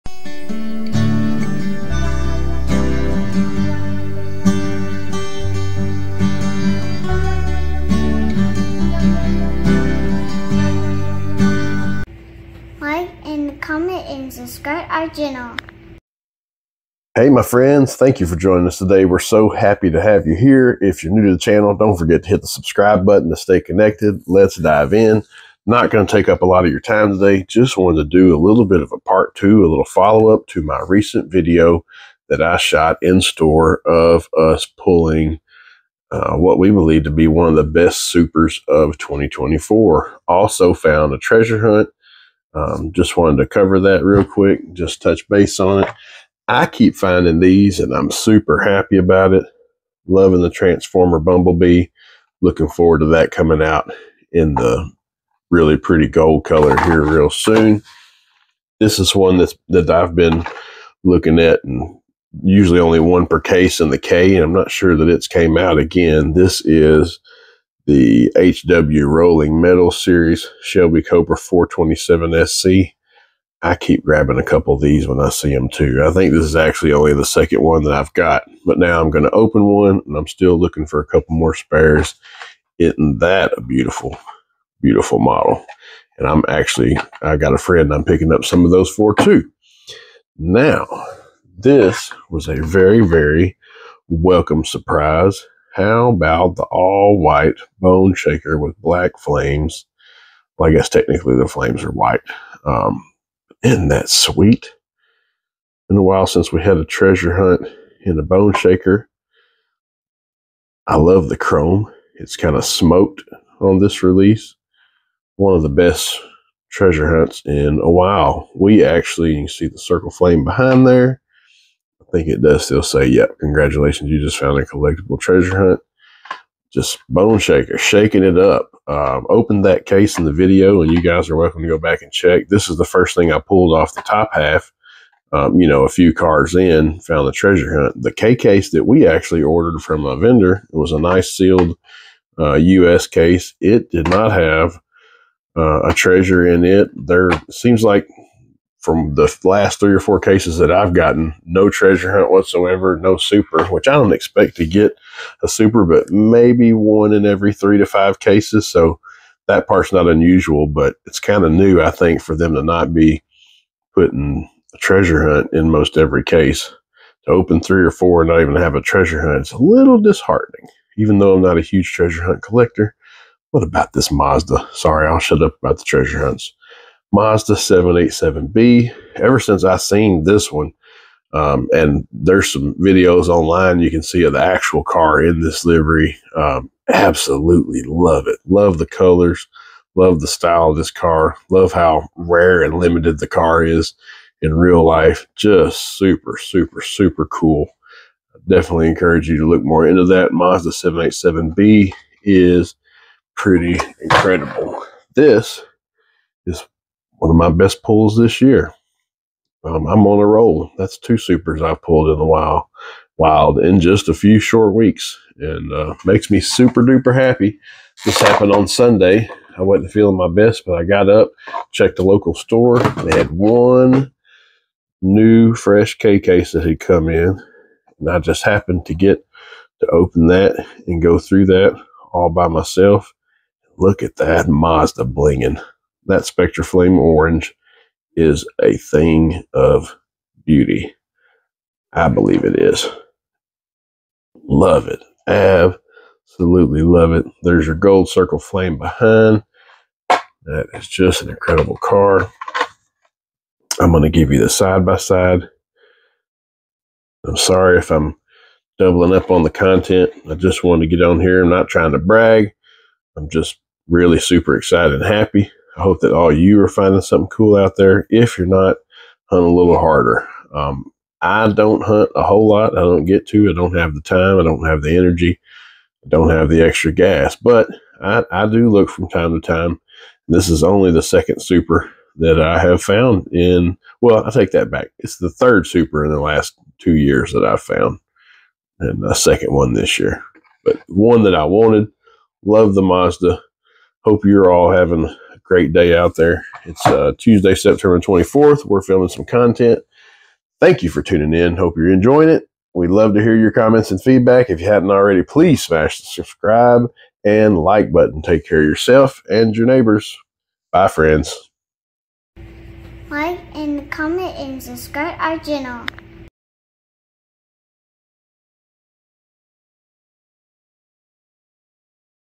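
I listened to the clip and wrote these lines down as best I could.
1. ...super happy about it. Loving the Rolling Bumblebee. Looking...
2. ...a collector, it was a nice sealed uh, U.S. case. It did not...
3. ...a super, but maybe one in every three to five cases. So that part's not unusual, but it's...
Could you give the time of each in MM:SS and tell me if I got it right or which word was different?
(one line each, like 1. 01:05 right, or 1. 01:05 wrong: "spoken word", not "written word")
1. 00:48 wrong: "Transformer", not "Rolling"
2. 02:20 wrong: "vendor", not "collector"
3. 02:35 right.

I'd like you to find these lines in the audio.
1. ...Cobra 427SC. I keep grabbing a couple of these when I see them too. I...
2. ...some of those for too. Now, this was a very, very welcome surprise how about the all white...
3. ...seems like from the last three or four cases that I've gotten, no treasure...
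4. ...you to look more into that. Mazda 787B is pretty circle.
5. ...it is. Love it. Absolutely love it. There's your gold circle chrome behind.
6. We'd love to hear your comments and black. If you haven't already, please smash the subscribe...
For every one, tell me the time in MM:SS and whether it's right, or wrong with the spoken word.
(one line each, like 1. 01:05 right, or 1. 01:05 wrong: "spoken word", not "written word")
1. 01:11 right
2. 01:28 right
3. 02:27 right
4. 03:19 wrong: "incredible", not "circle"
5. 04:02 wrong: "flame", not "chrome"
6. 05:02 wrong: "feedback", not "black".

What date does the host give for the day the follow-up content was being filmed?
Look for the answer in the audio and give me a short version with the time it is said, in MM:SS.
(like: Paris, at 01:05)
Tuesday, September 24th, at 04:57.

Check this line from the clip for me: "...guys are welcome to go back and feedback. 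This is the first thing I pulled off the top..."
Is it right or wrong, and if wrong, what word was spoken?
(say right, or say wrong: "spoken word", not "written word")
wrong: "check", not "feedback".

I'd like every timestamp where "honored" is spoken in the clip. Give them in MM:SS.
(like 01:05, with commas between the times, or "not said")
not said.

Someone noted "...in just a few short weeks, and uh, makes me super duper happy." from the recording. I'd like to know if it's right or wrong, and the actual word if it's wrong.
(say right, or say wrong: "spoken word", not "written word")
right.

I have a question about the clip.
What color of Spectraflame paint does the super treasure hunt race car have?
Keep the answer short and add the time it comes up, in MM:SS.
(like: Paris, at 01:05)
Orange, at 03:56.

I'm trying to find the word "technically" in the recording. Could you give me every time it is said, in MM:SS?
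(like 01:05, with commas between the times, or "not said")
01:40.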